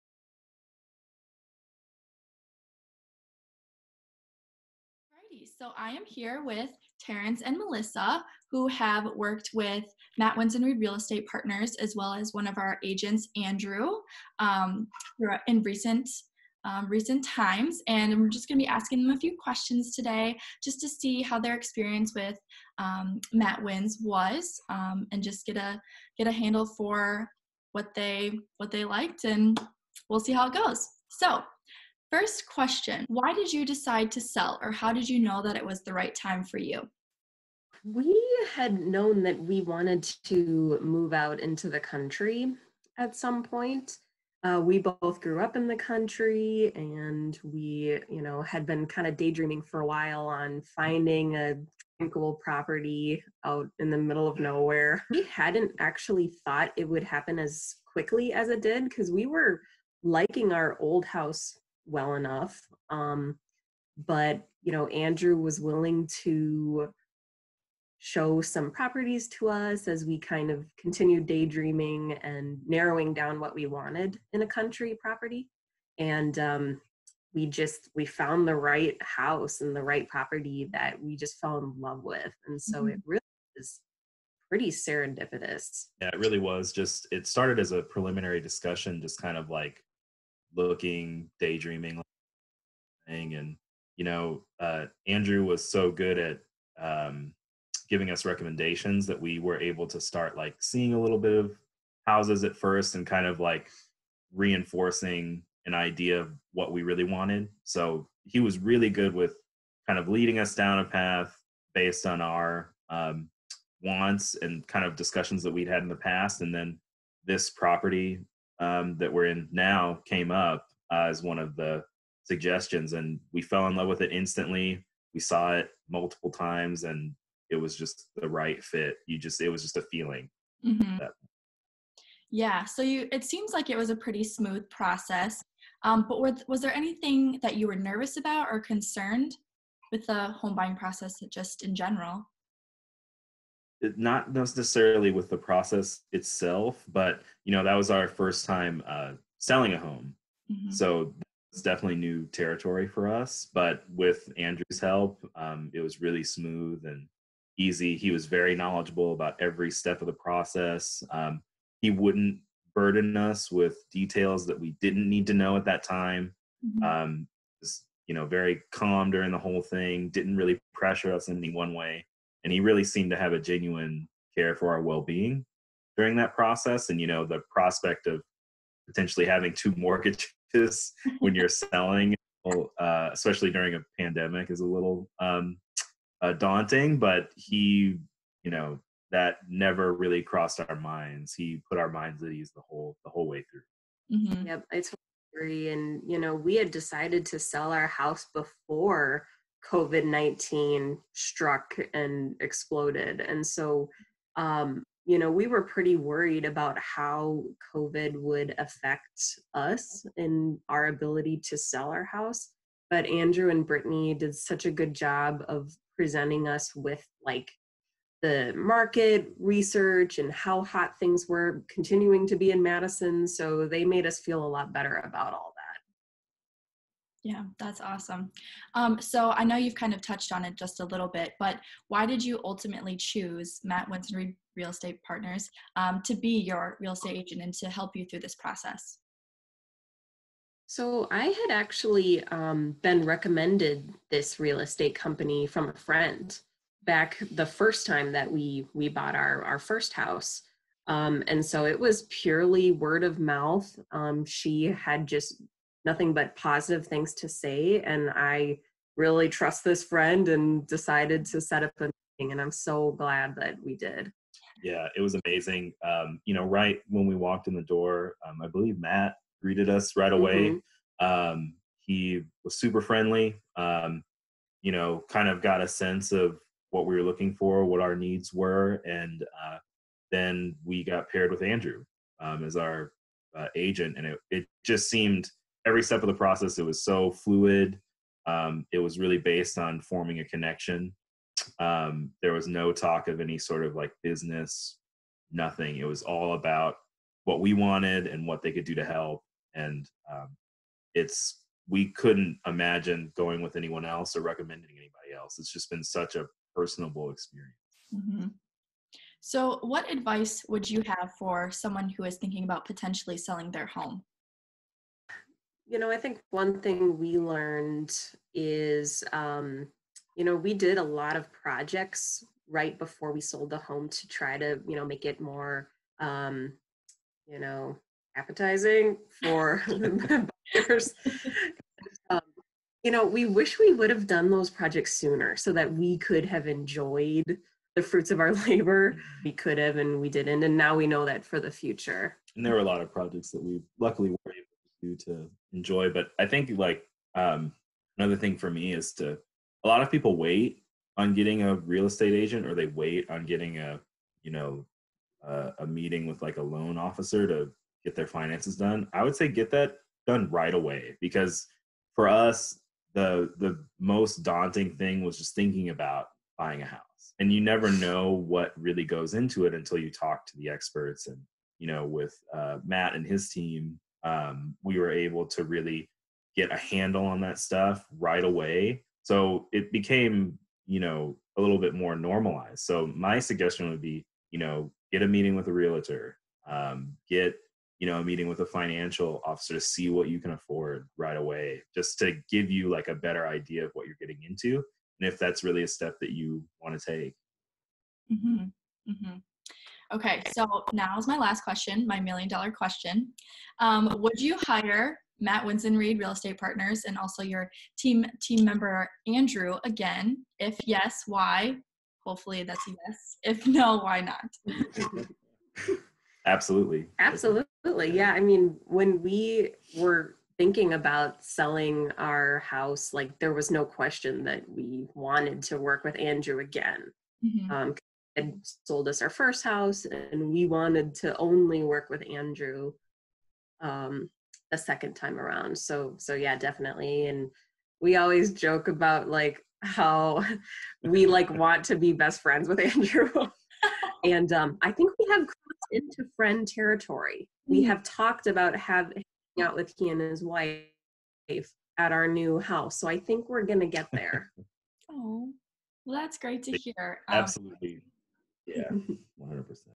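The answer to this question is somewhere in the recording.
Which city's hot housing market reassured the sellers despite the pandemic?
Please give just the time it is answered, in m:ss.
3:42.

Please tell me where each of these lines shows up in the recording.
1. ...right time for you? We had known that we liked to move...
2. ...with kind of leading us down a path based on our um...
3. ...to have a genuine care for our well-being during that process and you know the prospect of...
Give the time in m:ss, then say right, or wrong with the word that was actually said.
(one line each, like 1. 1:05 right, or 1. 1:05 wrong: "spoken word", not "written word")
1. 0:35 wrong: "wanted", not "liked"
2. 1:49 right
3. 2:53 right.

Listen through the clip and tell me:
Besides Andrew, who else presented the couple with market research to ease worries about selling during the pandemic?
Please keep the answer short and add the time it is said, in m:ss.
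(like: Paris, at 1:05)
Brittany, at 3:33.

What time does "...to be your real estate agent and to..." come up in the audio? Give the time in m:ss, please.
3:56.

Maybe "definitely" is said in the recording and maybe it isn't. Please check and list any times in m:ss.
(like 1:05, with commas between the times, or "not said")
2:31, 7:16.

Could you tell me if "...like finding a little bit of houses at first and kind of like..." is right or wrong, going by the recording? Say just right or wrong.
wrong.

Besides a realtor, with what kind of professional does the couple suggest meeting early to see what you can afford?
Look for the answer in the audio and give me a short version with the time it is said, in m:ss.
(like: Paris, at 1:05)
loan officer, at 5:56.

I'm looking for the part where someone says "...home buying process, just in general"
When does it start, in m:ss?
2:20.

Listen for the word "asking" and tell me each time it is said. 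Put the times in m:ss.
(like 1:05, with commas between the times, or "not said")
0:18.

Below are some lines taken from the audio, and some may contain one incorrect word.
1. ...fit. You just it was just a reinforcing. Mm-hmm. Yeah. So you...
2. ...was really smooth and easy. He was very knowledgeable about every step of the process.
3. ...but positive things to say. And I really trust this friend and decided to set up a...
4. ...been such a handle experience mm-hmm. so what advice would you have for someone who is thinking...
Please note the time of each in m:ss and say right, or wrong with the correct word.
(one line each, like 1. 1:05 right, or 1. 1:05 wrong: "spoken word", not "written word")
1. 2:08 wrong: "feeling", not "reinforcing"
2. 2:35 right
3. 4:16 right
4. 5:05 wrong: "personable", not "handle".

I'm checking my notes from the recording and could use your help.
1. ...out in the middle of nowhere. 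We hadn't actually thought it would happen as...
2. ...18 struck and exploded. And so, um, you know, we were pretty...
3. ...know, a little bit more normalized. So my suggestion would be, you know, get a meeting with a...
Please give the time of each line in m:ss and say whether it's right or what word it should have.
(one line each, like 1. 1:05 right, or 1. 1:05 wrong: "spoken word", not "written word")
1. 0:53 right
2. 3:20 wrong: "19", not "18"
3. 6:20 right.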